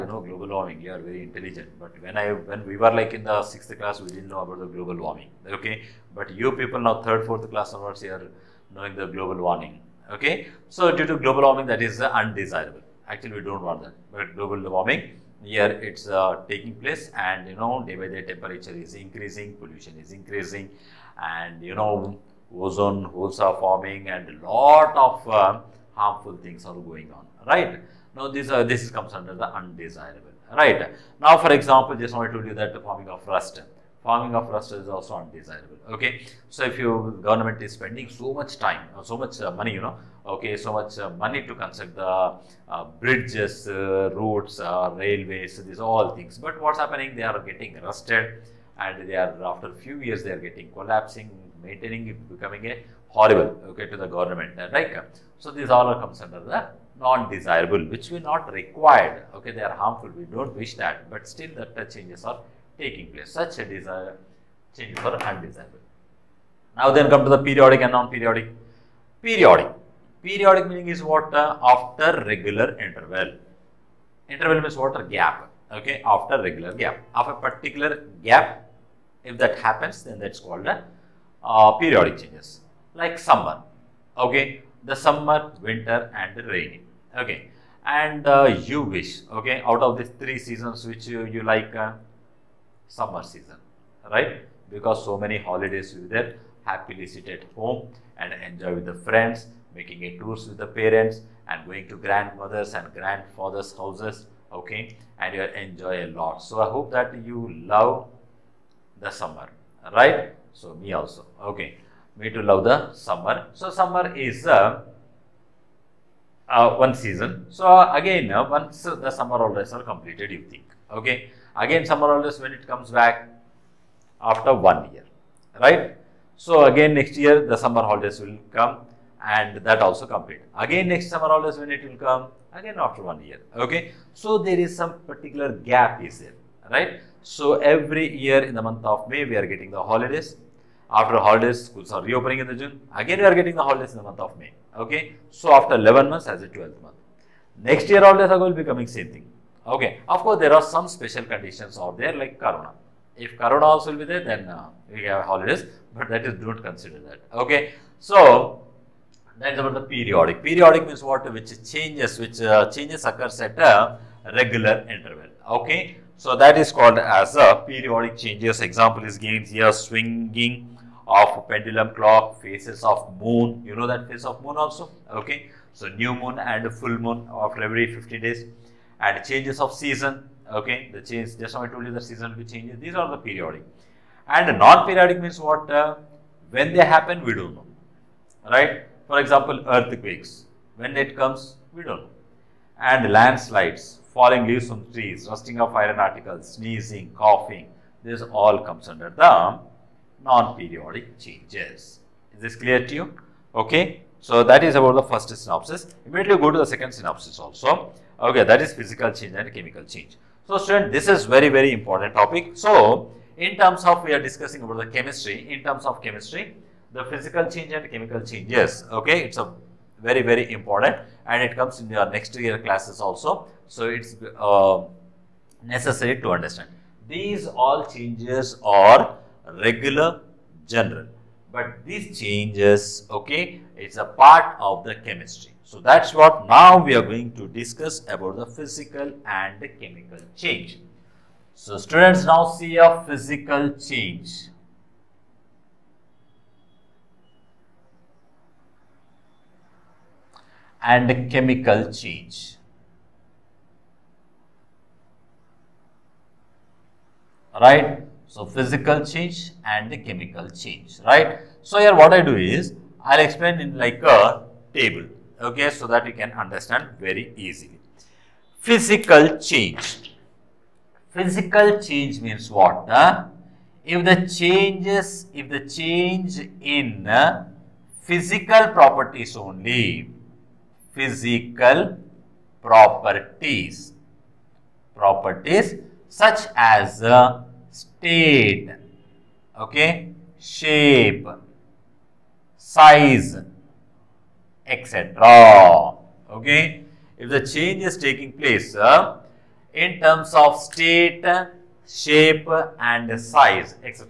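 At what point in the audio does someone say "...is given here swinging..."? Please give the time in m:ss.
2:49.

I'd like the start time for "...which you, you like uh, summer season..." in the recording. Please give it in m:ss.
1:30.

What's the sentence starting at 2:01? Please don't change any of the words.
Again summer holidays when it comes back after one year right.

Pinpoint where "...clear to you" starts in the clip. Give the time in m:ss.
3:22.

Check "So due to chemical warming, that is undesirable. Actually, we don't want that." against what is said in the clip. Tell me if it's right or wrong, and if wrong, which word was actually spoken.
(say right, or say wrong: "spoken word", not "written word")
wrong: "global", not "chemical".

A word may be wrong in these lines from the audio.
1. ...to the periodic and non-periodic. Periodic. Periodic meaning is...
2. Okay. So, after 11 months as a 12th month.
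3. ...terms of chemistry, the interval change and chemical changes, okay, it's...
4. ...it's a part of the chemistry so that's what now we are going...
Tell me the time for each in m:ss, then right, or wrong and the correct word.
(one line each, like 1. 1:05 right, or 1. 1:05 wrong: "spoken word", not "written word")
1. 1:07 right
2. 2:24 right
3. 3:35 wrong: "physical", not "interval"
4. 3:53 right.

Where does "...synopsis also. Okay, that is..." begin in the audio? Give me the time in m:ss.
3:26.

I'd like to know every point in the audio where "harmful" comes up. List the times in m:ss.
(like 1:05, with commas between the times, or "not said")
0:25, 0:59.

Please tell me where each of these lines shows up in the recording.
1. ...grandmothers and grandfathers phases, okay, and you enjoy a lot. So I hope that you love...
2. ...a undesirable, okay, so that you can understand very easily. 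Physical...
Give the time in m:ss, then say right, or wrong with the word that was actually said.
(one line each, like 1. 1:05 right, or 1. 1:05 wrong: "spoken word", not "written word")
1. 1:41 wrong: "houses", not "phases"
2. 4:24 wrong: "table", not "undesirable".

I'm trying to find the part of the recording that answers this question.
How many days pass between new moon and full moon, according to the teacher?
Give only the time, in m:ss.
2:57.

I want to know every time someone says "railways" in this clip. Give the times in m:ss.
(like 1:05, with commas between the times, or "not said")
0:44.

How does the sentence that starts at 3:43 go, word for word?
So, it's uh, necessary to understand.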